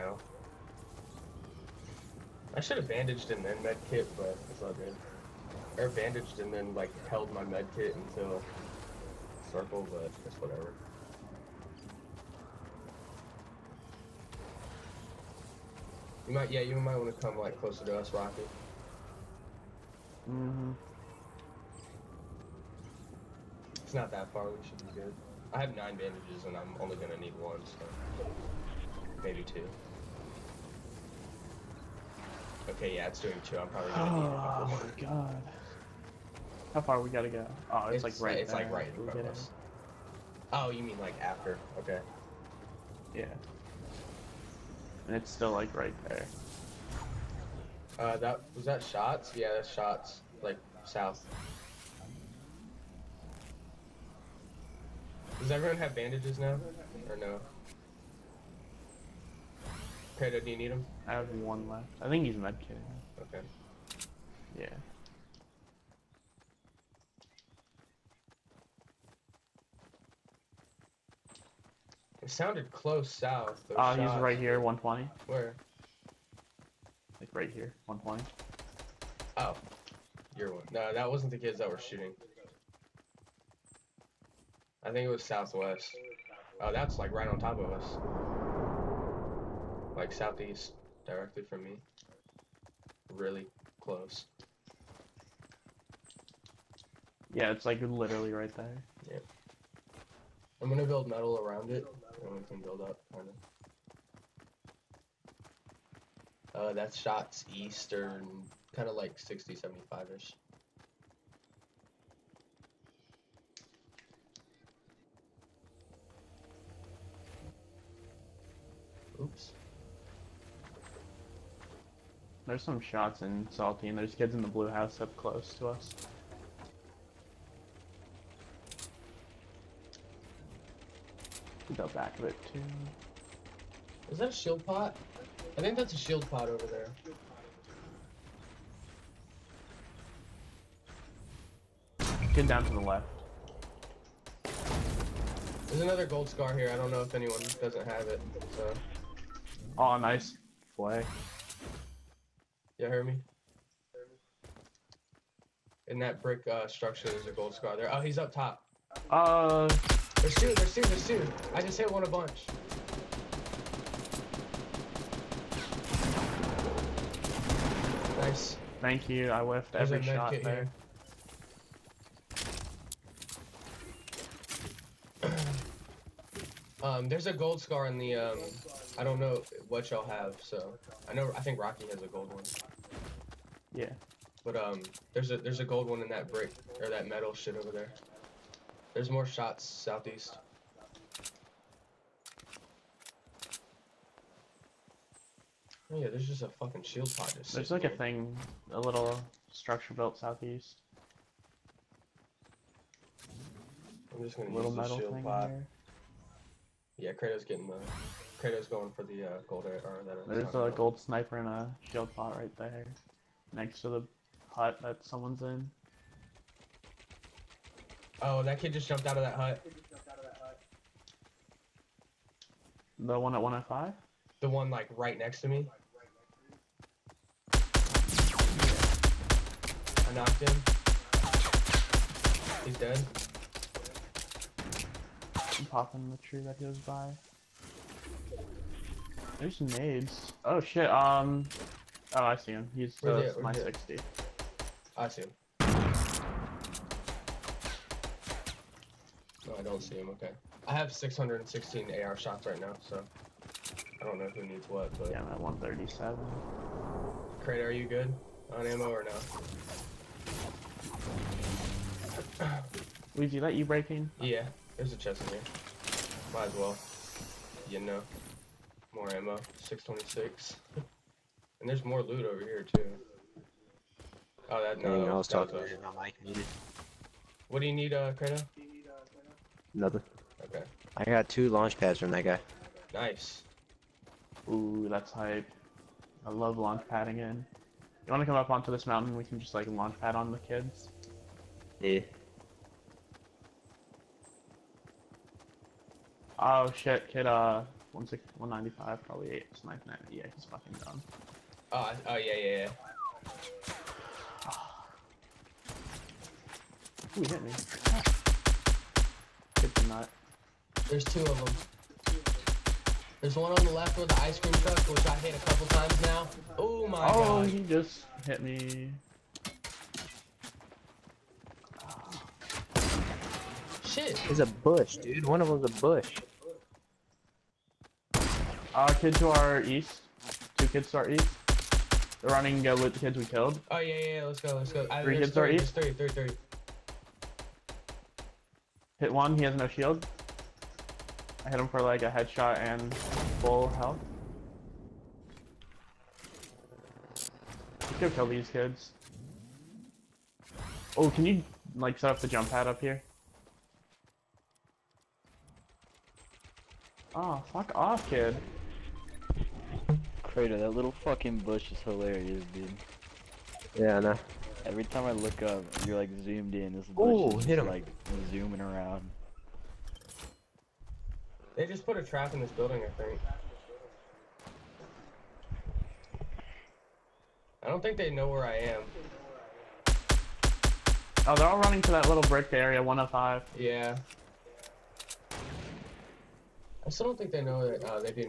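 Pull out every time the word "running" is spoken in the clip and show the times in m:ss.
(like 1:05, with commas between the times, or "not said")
5:32, 6:21.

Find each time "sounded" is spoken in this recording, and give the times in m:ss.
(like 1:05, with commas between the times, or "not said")
1:12.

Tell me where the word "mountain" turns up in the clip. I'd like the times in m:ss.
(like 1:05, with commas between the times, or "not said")
4:48.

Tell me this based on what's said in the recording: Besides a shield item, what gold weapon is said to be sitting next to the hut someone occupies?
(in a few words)
gold sniper.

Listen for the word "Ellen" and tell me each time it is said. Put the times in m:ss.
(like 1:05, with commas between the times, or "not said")
not said.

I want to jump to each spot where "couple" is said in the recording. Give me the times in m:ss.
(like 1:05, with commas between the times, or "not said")
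0:34, 5:15.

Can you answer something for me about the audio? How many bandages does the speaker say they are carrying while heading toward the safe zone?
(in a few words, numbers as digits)
9.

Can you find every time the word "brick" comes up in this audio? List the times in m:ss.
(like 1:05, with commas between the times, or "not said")
2:36, 3:06, 6:22.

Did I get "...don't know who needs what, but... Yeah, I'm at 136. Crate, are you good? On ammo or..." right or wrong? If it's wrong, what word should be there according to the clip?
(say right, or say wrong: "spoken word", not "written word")
wrong: "137", not "136".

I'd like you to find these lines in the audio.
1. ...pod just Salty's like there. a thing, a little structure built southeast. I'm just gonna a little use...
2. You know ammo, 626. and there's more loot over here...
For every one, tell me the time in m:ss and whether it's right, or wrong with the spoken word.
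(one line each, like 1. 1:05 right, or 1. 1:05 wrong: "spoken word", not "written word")
1. 3:17 wrong: "There", not "Salty"
2. 4:27 right.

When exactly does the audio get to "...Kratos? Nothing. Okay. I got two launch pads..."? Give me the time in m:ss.
4:38.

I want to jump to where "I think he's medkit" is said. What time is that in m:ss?
1:01.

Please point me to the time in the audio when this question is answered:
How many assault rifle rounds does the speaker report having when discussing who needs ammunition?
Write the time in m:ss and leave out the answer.
4:10.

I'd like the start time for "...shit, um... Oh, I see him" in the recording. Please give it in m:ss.
4:00.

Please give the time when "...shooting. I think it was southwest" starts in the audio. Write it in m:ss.
1:21.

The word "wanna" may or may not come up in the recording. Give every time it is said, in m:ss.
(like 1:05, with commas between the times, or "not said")
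4:48.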